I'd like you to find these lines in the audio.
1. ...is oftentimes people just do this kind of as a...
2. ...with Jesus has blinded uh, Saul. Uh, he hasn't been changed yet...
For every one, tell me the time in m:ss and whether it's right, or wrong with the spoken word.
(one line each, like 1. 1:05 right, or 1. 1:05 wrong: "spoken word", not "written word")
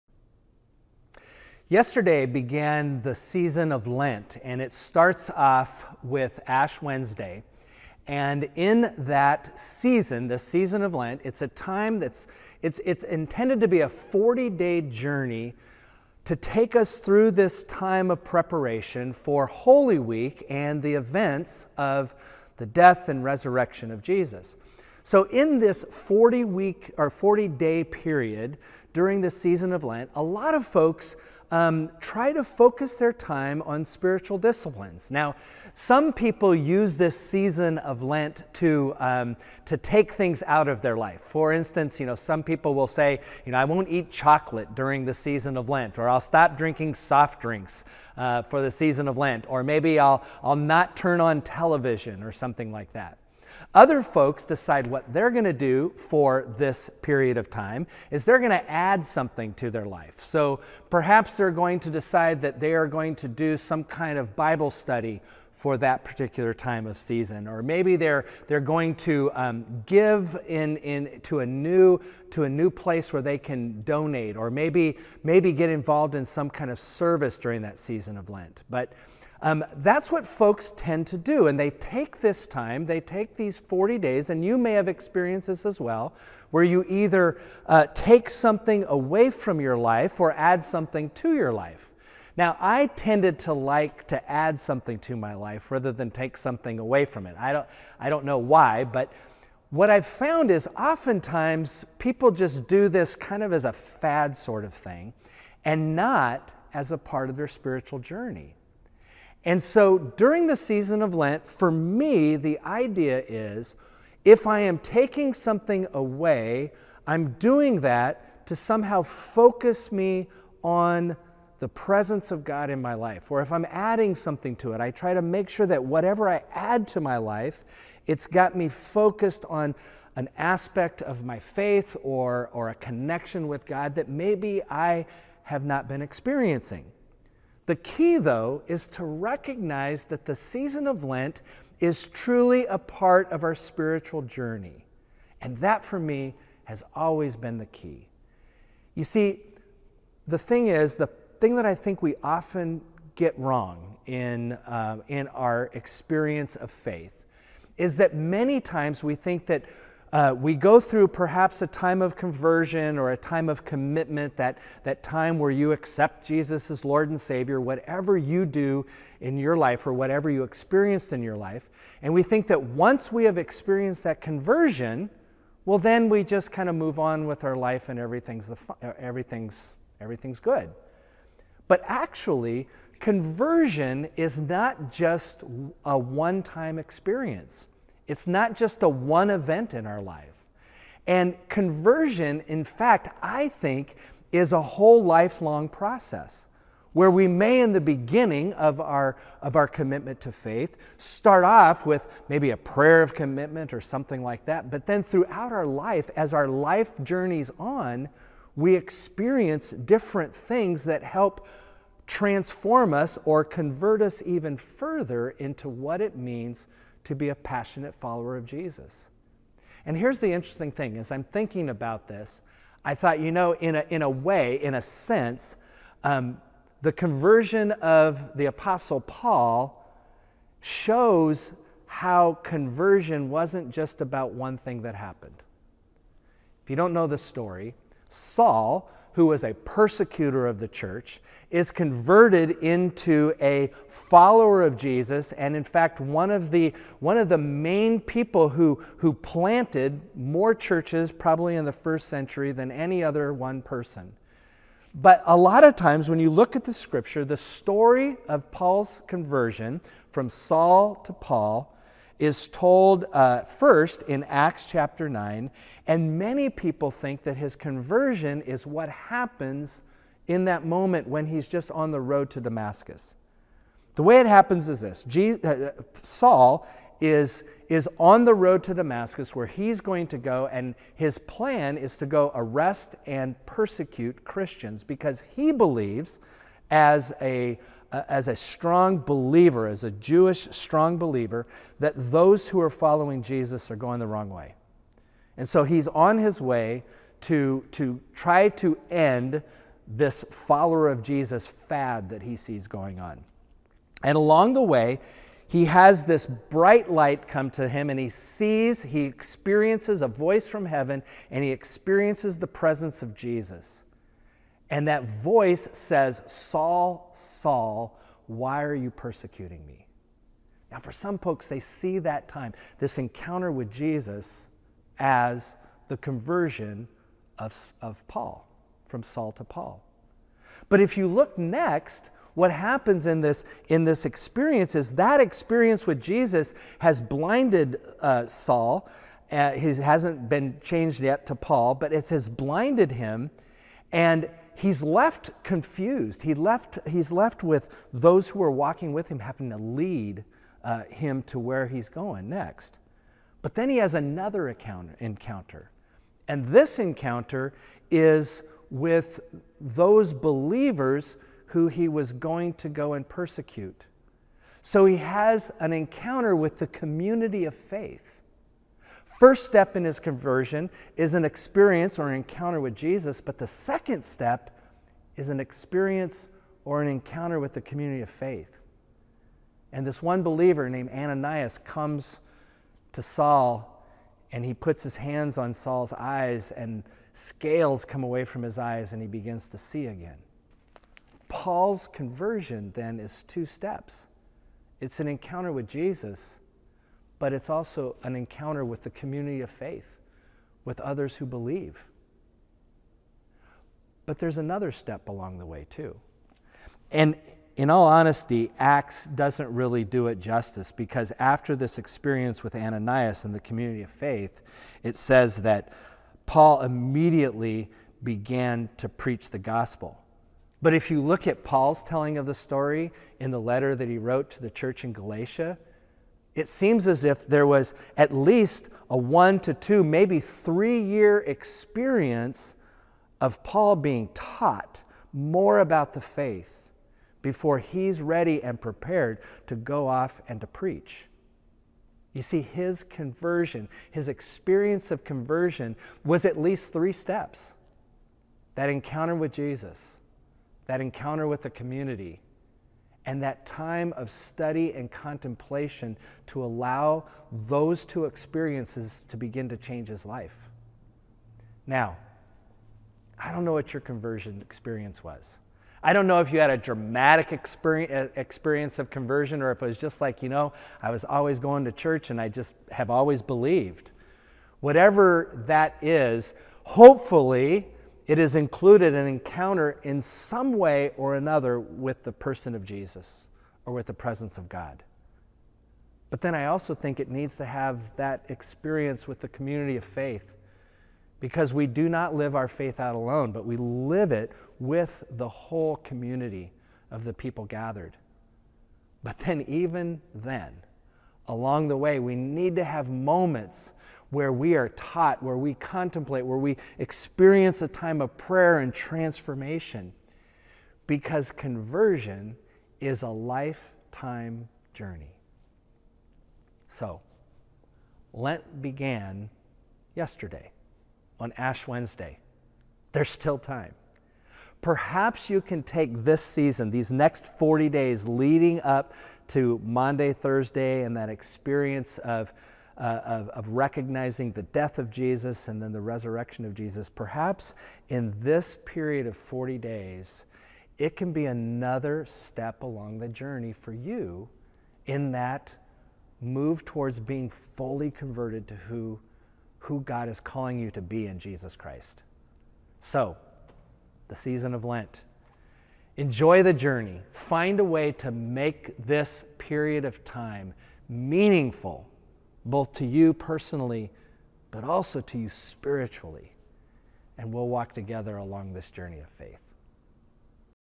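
1. 1:40 right
2. 5:35 right.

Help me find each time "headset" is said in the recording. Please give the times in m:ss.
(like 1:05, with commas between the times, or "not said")
not said.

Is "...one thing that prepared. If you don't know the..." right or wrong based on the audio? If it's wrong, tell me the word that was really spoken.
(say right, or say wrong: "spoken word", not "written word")
wrong: "happened", not "prepared".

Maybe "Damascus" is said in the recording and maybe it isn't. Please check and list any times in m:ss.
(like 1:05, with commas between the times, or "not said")
4:32, 4:38.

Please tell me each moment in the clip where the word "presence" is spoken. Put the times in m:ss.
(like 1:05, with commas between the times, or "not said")
2:01, 5:12, 8:03.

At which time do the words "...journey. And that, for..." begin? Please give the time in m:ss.
2:24.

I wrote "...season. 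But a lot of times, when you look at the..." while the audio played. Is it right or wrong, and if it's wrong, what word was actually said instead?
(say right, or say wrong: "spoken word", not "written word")
wrong: "person", not "season".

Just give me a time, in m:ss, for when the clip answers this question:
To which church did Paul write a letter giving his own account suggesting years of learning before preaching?
7:04.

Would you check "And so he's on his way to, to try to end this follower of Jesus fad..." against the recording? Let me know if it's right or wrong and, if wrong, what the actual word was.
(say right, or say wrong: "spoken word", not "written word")
right.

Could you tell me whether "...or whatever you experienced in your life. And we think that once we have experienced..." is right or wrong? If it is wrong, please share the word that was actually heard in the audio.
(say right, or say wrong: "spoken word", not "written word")
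right.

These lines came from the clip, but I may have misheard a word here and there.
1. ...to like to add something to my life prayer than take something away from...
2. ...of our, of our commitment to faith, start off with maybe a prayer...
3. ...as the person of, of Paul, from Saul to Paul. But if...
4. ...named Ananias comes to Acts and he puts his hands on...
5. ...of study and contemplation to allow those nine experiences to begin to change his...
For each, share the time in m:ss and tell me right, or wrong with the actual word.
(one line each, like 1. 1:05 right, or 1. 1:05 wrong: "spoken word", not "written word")
1. 1:33 wrong: "rather", not "prayer"
2. 3:18 right
3. 5:24 wrong: "conversion", not "person"
4. 6:20 wrong: "Saul", not "Acts"
5. 7:33 wrong: "two", not "nine".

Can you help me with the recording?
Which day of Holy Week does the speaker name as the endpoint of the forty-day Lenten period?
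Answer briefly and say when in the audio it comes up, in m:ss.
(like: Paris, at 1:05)
Maundy Thursday, at 8:49.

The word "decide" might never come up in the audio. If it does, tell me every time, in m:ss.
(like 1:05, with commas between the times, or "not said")
0:54, 1:01.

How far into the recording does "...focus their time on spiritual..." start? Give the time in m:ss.
0:32.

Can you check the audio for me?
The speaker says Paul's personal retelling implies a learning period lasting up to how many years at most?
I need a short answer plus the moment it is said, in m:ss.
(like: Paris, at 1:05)
3 years, at 7:10.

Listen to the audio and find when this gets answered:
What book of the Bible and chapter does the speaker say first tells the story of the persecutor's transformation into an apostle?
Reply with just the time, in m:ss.
4:24.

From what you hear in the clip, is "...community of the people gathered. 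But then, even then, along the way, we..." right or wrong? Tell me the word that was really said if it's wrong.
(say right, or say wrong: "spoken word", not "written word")
right.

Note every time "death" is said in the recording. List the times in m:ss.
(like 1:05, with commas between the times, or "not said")
0:22, 8:54.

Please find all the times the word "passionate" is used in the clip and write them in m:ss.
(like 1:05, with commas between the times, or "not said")
3:37.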